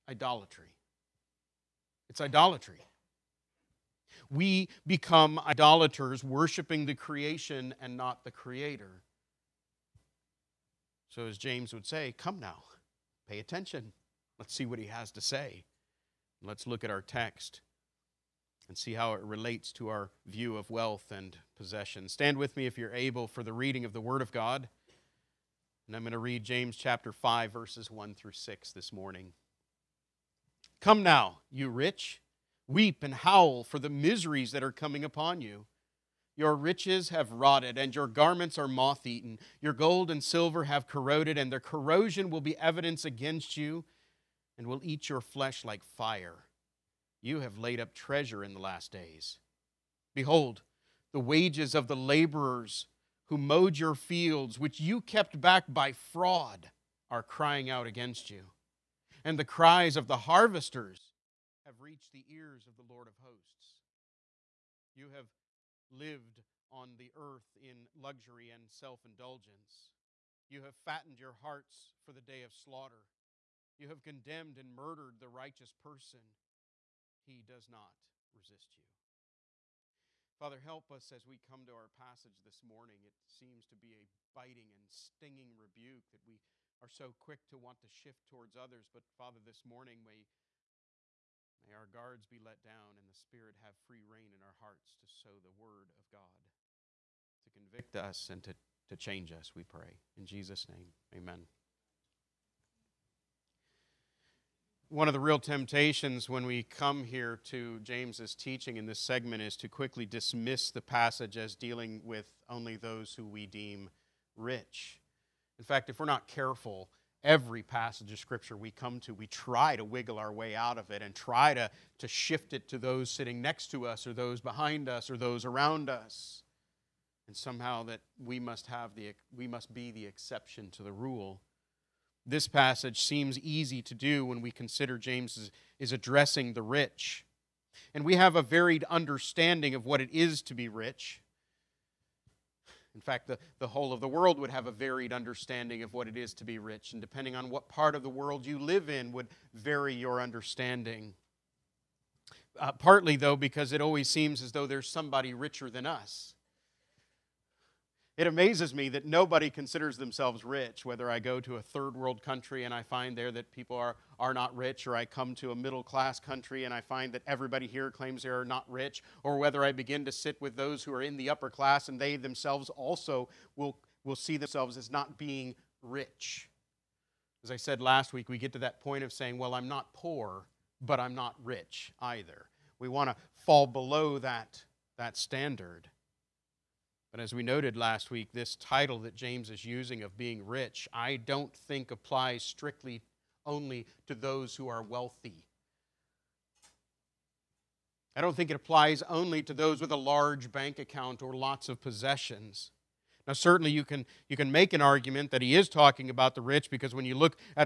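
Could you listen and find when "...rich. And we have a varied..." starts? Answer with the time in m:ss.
2:16.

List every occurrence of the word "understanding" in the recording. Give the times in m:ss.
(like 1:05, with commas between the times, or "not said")
2:18, 2:25, 2:30.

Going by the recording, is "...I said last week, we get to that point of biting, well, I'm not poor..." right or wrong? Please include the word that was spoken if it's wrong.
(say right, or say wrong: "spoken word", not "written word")
wrong: "saying", not "biting".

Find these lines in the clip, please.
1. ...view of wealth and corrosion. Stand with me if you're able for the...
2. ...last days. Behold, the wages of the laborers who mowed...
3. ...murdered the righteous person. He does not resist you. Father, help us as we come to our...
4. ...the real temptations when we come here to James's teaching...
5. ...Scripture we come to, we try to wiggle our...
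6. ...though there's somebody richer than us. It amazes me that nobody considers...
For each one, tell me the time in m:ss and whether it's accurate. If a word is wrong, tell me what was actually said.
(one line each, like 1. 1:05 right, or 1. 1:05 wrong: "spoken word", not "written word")
1. 0:20 wrong: "possession", not "corrosion"
2. 0:48 right
3. 1:14 right
4. 1:45 right
5. 1:58 right
6. 2:34 right.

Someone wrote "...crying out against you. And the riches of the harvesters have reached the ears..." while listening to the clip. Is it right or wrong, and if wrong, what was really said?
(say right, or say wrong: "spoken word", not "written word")
wrong: "cries", not "riches".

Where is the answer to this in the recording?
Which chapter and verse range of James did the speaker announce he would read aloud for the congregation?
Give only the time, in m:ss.
0:26.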